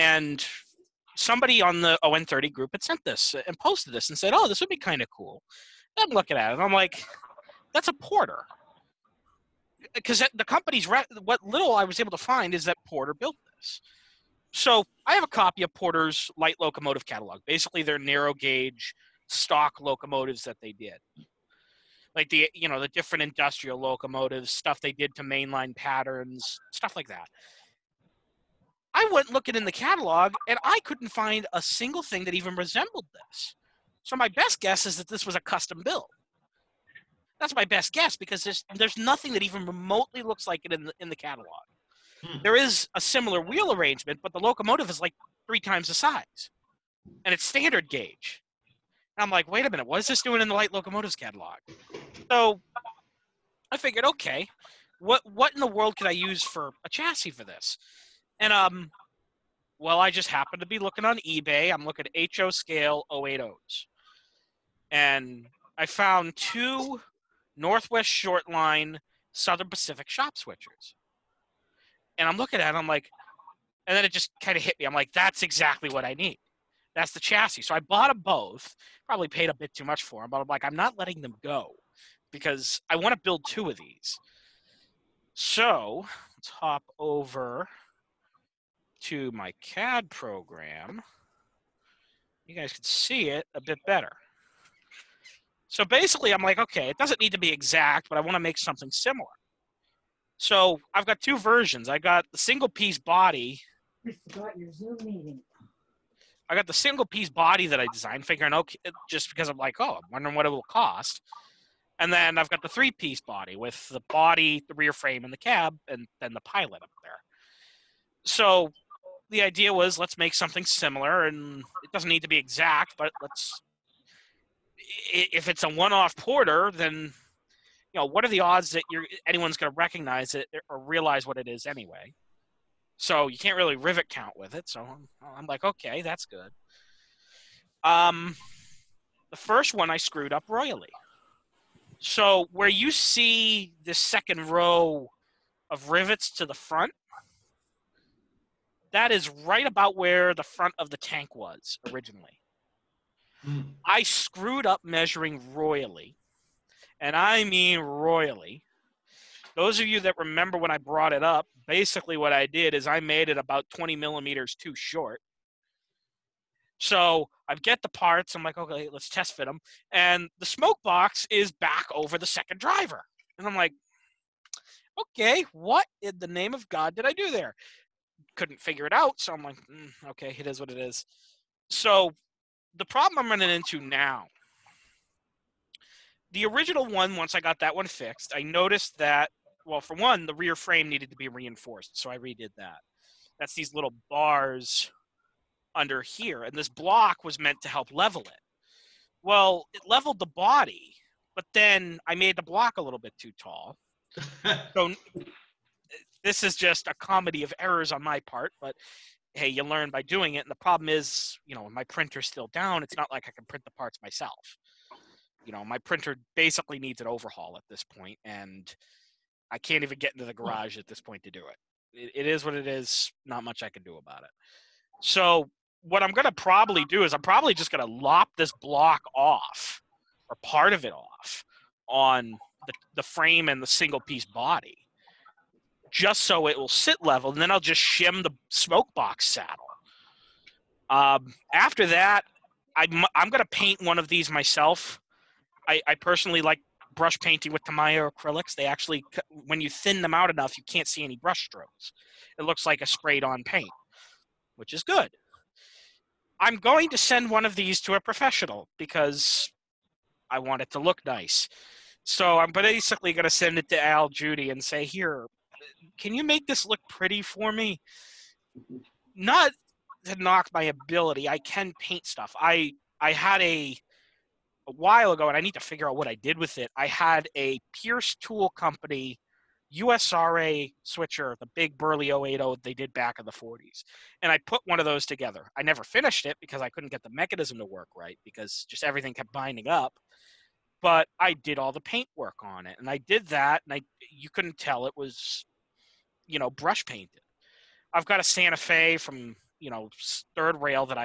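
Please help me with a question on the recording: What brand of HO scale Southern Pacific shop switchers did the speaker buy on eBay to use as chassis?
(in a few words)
Northwest Short Line.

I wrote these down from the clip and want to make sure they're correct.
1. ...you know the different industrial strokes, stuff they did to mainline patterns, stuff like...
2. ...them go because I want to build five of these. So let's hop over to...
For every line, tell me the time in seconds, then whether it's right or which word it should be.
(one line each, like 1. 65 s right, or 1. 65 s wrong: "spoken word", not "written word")
1. 22 s wrong: "locomotives", not "strokes"
2. 81 s wrong: "two", not "five".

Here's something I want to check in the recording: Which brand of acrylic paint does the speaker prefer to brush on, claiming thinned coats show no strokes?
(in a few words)
Tamiya.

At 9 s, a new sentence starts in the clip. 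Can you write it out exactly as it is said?
Because the company's what little I was able to find is that Porter built this.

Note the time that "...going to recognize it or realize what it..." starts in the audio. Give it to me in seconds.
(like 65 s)
129 s.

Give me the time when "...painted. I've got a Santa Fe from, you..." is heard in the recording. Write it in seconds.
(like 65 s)
296 s.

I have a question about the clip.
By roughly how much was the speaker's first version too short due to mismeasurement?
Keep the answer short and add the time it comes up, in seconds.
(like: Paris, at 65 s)
20 millimeters, at 163 s.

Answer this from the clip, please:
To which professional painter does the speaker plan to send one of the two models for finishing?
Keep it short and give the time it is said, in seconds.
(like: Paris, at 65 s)
Al Judy, at 263 s.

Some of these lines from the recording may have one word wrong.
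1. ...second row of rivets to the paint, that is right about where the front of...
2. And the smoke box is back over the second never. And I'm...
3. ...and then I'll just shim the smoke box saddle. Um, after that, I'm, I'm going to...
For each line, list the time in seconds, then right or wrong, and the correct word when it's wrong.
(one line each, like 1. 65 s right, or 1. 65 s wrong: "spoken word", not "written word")
1. 143 s wrong: "front", not "paint"
2. 169 s wrong: "driver", not "never"
3. 237 s right.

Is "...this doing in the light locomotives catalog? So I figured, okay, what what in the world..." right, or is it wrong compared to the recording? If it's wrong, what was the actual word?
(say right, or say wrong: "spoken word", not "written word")
right.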